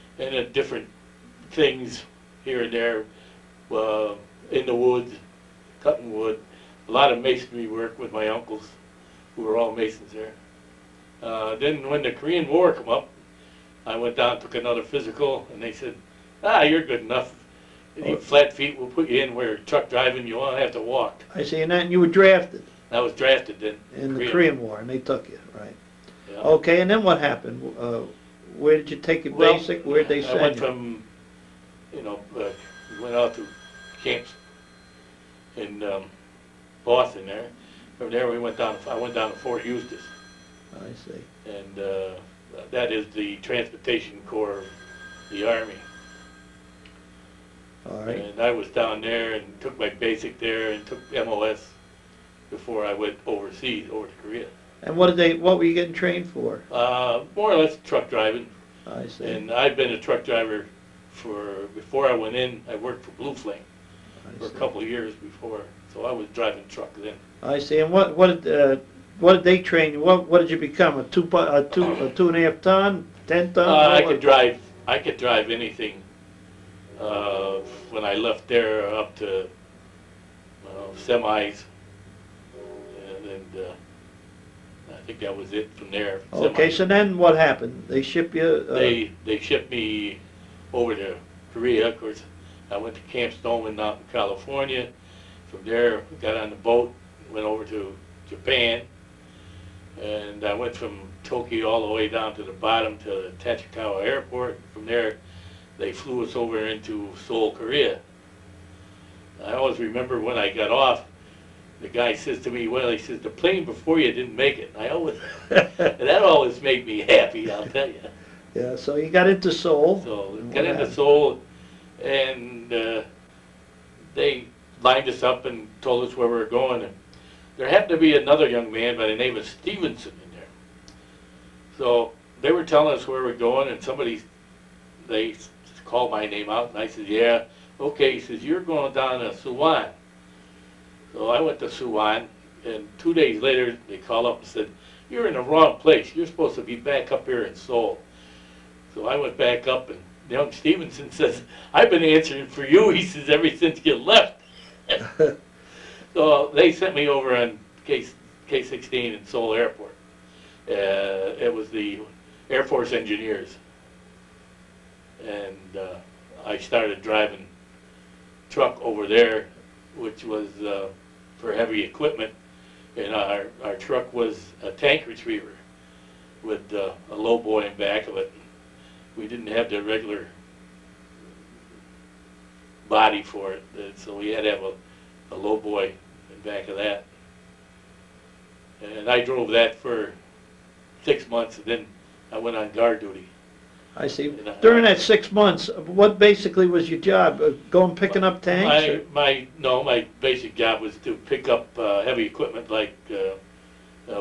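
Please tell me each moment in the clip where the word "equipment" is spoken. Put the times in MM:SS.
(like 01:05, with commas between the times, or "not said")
02:51, 03:22.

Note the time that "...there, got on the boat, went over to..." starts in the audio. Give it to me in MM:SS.
01:35.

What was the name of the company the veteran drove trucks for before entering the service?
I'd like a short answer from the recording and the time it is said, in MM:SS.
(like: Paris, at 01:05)
Blue Flame, at 01:03.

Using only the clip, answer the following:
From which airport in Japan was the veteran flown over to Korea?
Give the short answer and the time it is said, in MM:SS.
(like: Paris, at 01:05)
Tachikawa Airport, at 01:43.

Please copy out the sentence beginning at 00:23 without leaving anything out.
in the Korean War, and they took you, right?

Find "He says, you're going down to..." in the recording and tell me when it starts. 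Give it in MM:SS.
02:18.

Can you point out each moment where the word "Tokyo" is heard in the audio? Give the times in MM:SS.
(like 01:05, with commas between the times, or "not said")
01:41.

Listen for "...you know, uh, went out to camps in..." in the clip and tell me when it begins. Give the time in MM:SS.
00:31.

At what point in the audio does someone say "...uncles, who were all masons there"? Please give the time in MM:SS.
00:08.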